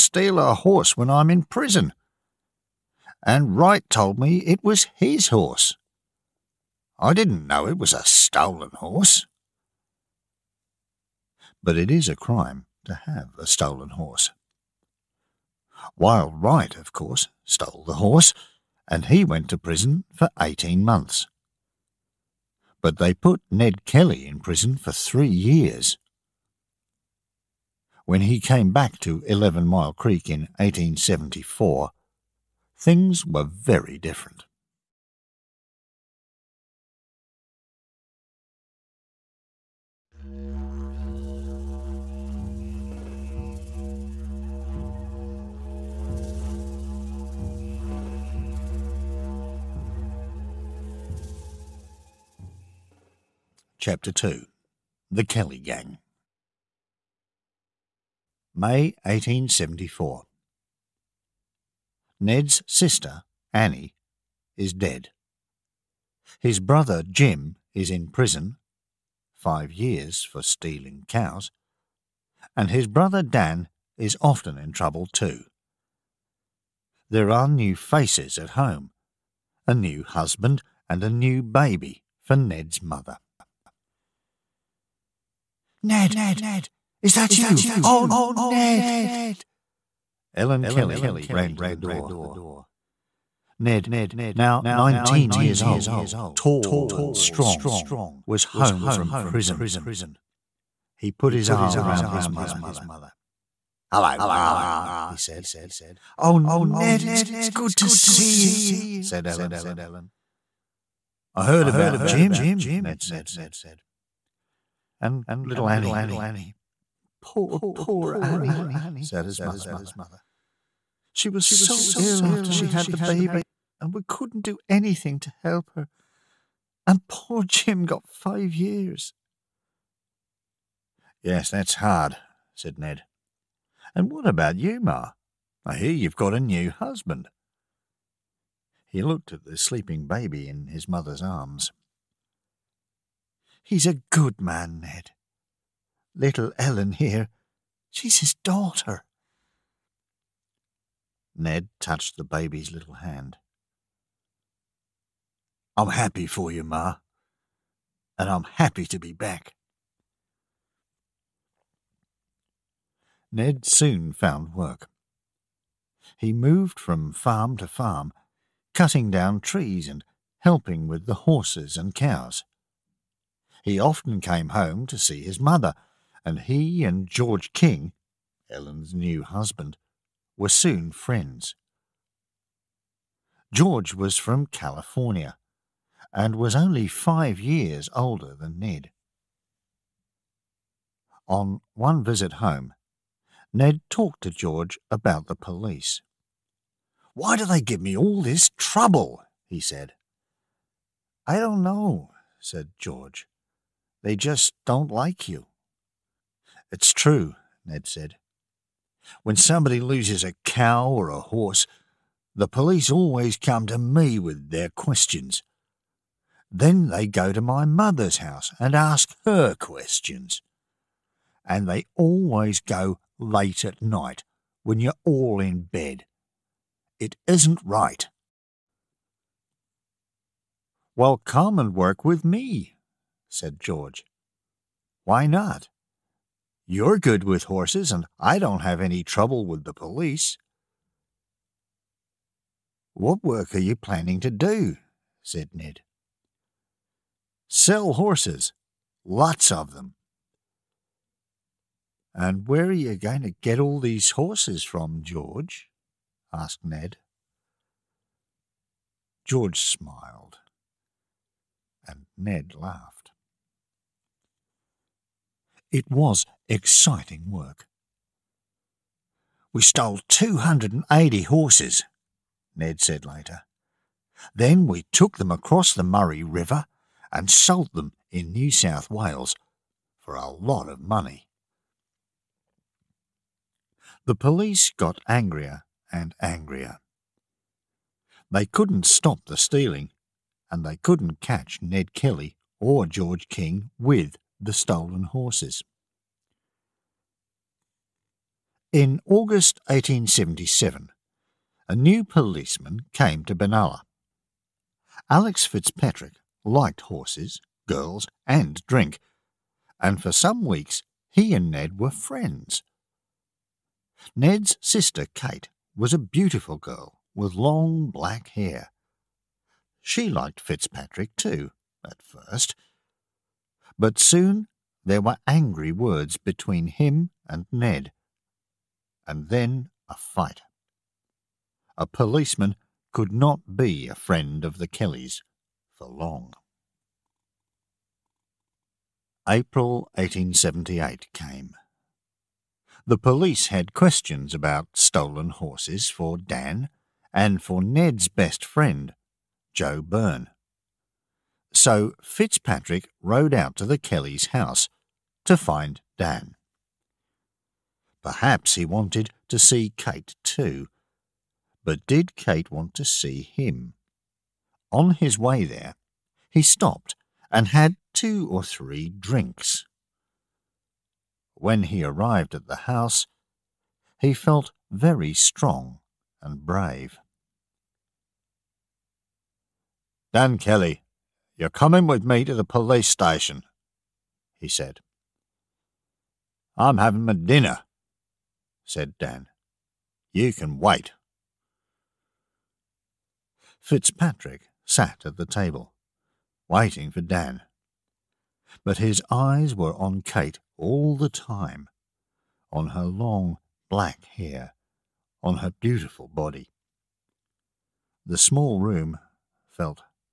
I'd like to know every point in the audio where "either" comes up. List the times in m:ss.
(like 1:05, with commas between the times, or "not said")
not said.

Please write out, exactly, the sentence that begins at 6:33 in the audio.
Fitzpatrick sat at the table, waiting for Dan.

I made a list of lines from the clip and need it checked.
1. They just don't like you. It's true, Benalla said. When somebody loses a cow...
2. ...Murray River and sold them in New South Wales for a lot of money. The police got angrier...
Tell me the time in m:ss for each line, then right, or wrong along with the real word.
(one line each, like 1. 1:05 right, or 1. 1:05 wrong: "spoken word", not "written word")
1. 3:24 wrong: "Ned", not "Benalla"
2. 4:35 right.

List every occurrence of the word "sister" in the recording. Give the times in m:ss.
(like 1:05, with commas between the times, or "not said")
1:02, 5:14.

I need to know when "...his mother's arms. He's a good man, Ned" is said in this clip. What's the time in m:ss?
2:20.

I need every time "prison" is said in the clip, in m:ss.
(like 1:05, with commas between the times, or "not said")
0:01, 0:19, 0:24, 1:08, 1:39.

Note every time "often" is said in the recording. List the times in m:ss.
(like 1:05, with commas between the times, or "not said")
1:14, 2:53.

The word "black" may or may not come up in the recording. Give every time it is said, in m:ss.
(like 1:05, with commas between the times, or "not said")
5:17, 6:43.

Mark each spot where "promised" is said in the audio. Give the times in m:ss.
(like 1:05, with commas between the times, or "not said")
not said.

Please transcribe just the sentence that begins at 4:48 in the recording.
They couldn't stop the stealing, and they couldn't catch Ned Kelly or George King with the stolen horses.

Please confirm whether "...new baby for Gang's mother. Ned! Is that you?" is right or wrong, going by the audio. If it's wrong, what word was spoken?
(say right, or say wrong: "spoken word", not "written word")
wrong: "Ned", not "Gang".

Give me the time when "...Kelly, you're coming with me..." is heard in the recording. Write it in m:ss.
6:20.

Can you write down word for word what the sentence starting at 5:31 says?
A policeman could not be a friend of the Kellys for long.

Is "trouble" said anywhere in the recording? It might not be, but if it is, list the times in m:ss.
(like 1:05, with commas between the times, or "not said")
1:14, 3:18, 3:59.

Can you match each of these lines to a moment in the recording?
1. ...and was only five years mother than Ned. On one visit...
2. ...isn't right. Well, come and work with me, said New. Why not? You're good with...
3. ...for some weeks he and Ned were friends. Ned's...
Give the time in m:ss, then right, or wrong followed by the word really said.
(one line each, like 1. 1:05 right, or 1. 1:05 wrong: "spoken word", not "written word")
1. 3:06 wrong: "older", not "mother"
2. 3:47 wrong: "George", not "New"
3. 5:10 right.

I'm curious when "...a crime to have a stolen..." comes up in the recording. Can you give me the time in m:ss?
0:12.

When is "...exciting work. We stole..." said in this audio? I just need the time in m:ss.
4:26.